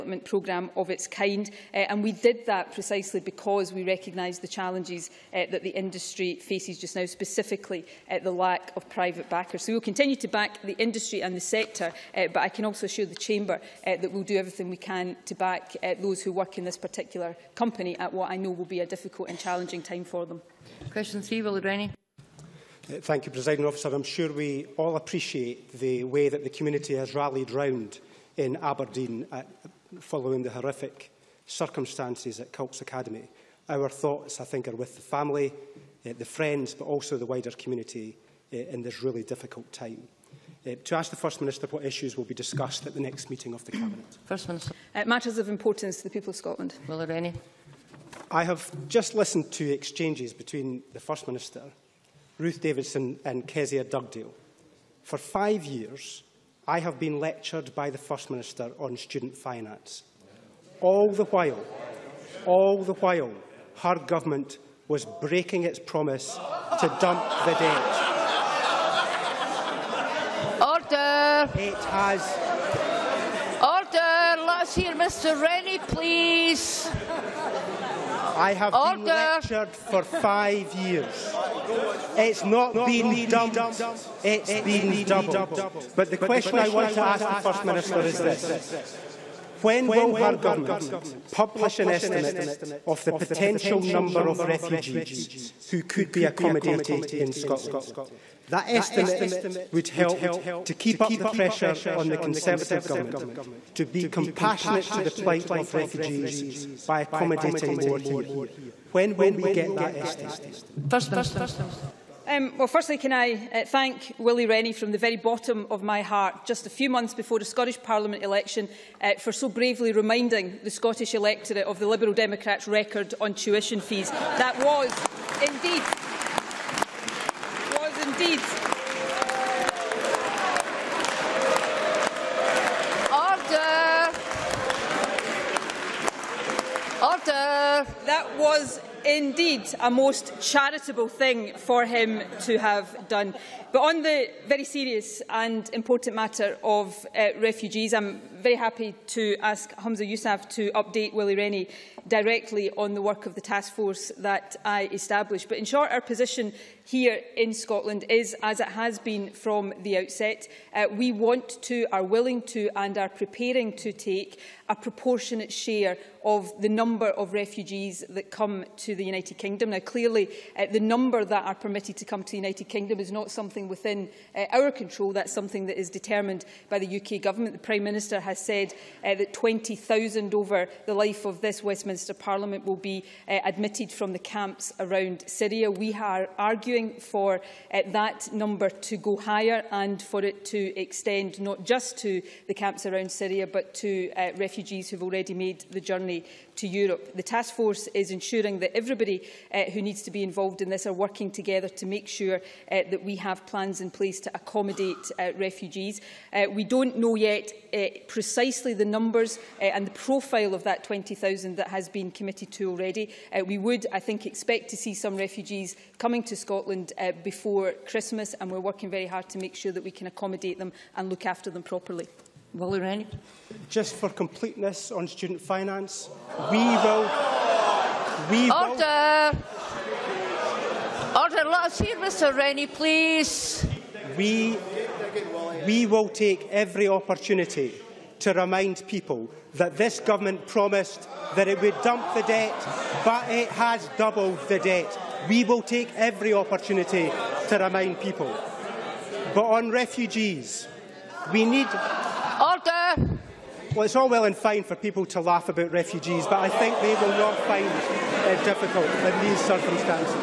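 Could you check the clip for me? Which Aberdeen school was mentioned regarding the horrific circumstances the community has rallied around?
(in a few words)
Cults Academy.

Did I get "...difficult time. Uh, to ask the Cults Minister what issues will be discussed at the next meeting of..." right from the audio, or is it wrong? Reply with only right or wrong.
wrong.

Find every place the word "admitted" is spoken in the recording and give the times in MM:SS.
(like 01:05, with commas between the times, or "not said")
03:03.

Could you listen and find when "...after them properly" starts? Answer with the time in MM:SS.
03:41.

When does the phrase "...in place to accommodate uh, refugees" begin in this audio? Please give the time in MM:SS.
03:23.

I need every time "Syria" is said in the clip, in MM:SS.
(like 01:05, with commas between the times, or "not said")
03:05, 03:13.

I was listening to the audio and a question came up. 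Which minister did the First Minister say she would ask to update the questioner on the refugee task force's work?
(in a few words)
Humza Yousaf.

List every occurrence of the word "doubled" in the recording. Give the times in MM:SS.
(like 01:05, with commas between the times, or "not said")
01:25, 04:03.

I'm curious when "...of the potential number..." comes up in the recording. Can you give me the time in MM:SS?
01:32.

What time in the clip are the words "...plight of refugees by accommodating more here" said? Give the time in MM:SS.
01:45.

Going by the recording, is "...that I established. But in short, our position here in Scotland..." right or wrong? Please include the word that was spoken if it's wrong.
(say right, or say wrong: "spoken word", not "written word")
right.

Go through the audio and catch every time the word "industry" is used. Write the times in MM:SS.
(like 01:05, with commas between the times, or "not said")
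00:05, 00:10.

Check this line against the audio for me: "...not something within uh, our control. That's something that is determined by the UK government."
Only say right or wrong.
right.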